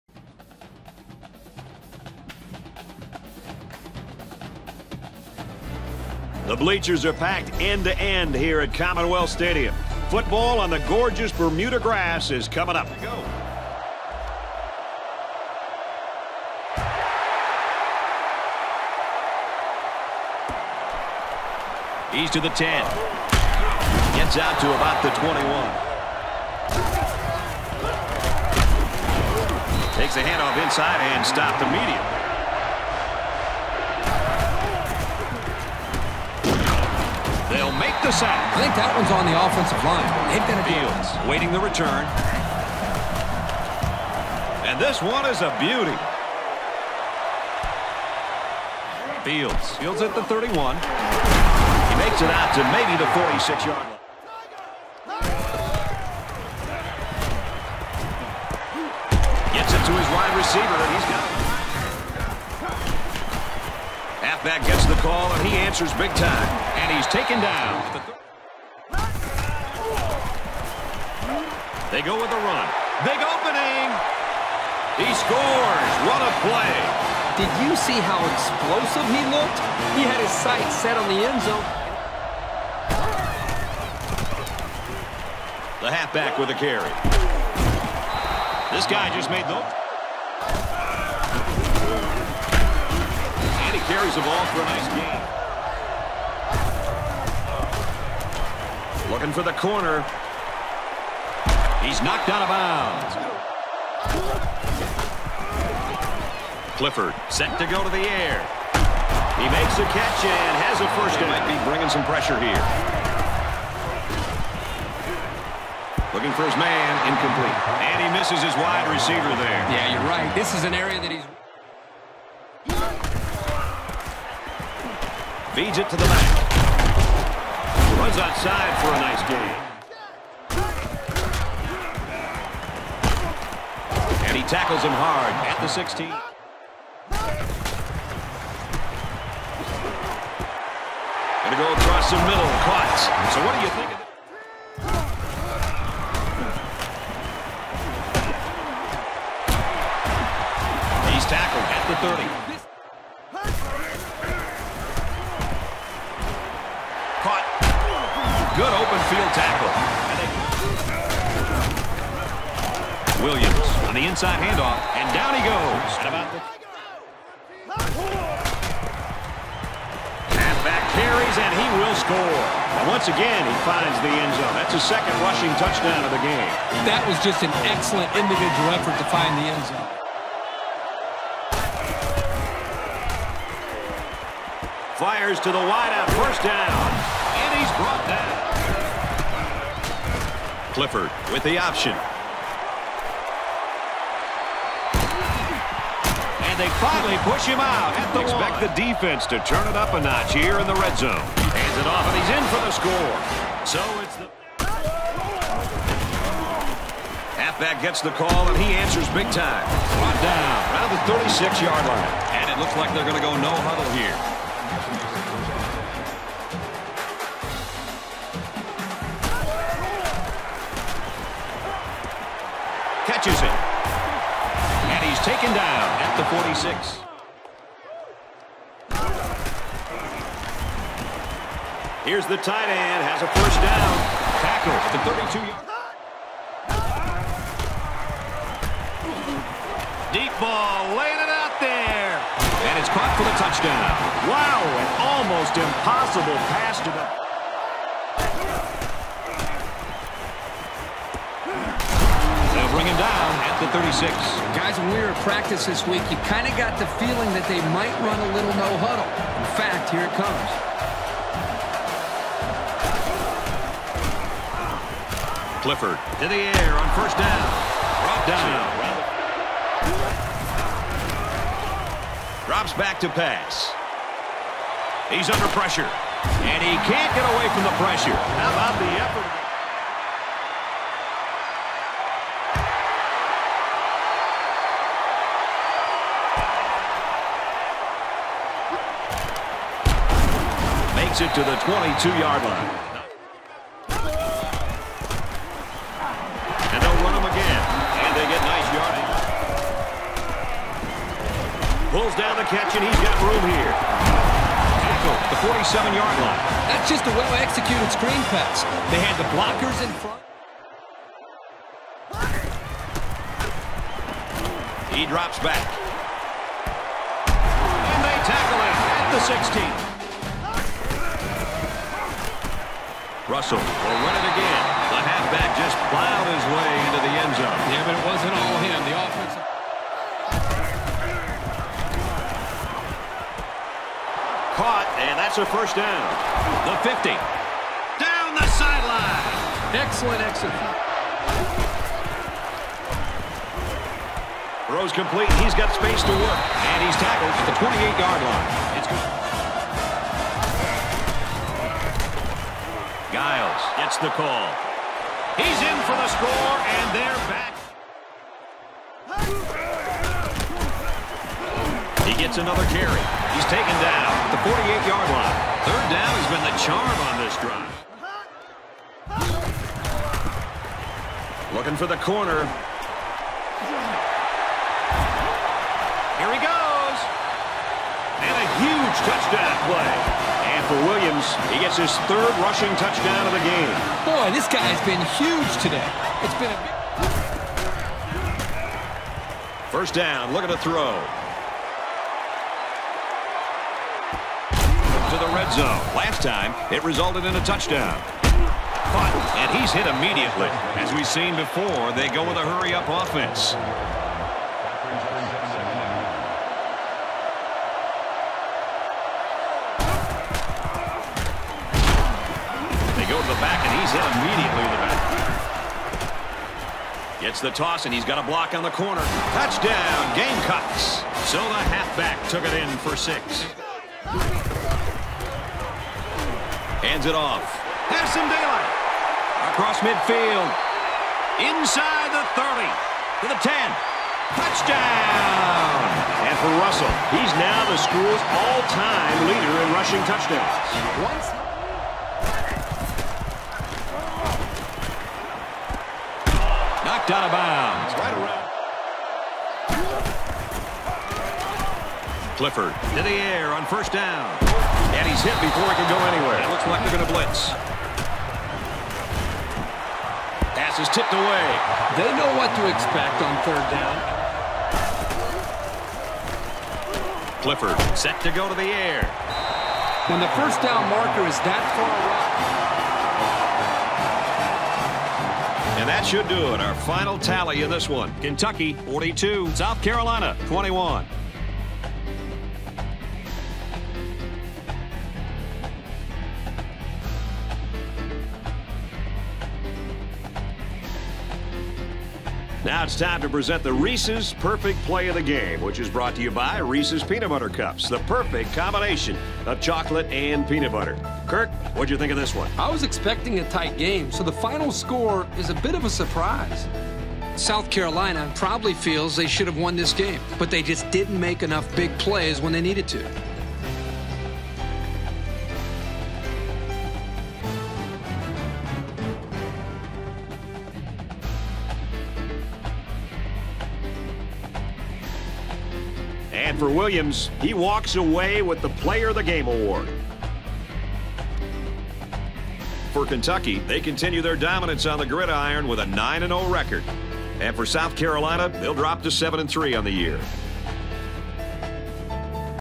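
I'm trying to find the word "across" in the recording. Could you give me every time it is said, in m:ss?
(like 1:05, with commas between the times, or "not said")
2:21, 7:09.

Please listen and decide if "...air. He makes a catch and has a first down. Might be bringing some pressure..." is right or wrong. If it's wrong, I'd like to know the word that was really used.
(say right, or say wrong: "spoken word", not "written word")
right.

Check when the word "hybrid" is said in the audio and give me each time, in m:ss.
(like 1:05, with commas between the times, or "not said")
not said.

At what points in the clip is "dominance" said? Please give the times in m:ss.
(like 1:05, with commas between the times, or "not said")
8:54.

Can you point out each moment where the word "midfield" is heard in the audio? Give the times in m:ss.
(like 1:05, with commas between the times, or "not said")
2:39, 7:09.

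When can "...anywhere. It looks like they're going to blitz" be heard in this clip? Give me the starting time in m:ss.
7:36.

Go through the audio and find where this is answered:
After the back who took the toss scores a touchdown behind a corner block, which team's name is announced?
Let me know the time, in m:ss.
7:00.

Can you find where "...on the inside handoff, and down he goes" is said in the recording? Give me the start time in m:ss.
2:43.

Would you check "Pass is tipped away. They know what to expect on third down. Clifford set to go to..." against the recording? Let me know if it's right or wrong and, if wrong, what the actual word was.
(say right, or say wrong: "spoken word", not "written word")
right.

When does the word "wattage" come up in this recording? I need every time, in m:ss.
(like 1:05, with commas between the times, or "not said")
not said.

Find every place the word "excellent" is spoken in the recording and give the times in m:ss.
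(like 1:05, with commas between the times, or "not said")
2:57, 5:39.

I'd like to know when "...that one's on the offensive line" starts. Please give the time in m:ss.
0:38.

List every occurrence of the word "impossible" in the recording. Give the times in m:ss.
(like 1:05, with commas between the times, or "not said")
4:05.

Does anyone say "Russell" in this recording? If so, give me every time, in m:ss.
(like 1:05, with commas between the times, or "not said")
5:23, 7:16.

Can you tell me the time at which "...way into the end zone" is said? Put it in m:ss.
5:26.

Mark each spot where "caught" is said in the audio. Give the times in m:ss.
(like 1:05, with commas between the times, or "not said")
2:22, 4:02, 5:34.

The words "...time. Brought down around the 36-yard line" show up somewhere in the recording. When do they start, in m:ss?
3:29.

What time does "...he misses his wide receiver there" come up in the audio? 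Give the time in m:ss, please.
1:58.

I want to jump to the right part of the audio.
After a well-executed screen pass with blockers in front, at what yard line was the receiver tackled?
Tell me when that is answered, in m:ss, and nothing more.
5:05.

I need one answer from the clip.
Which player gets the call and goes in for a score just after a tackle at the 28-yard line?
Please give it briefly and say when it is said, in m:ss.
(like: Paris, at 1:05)
Giles, at 5:53.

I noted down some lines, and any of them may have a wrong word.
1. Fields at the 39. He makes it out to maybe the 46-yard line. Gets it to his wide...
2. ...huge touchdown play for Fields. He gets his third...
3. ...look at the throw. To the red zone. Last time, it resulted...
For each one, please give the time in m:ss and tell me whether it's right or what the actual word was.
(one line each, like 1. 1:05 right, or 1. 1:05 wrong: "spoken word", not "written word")
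1. 0:49 wrong: "31", not "39"
2. 6:18 wrong: "Williams", not "Fields"
3. 6:30 right.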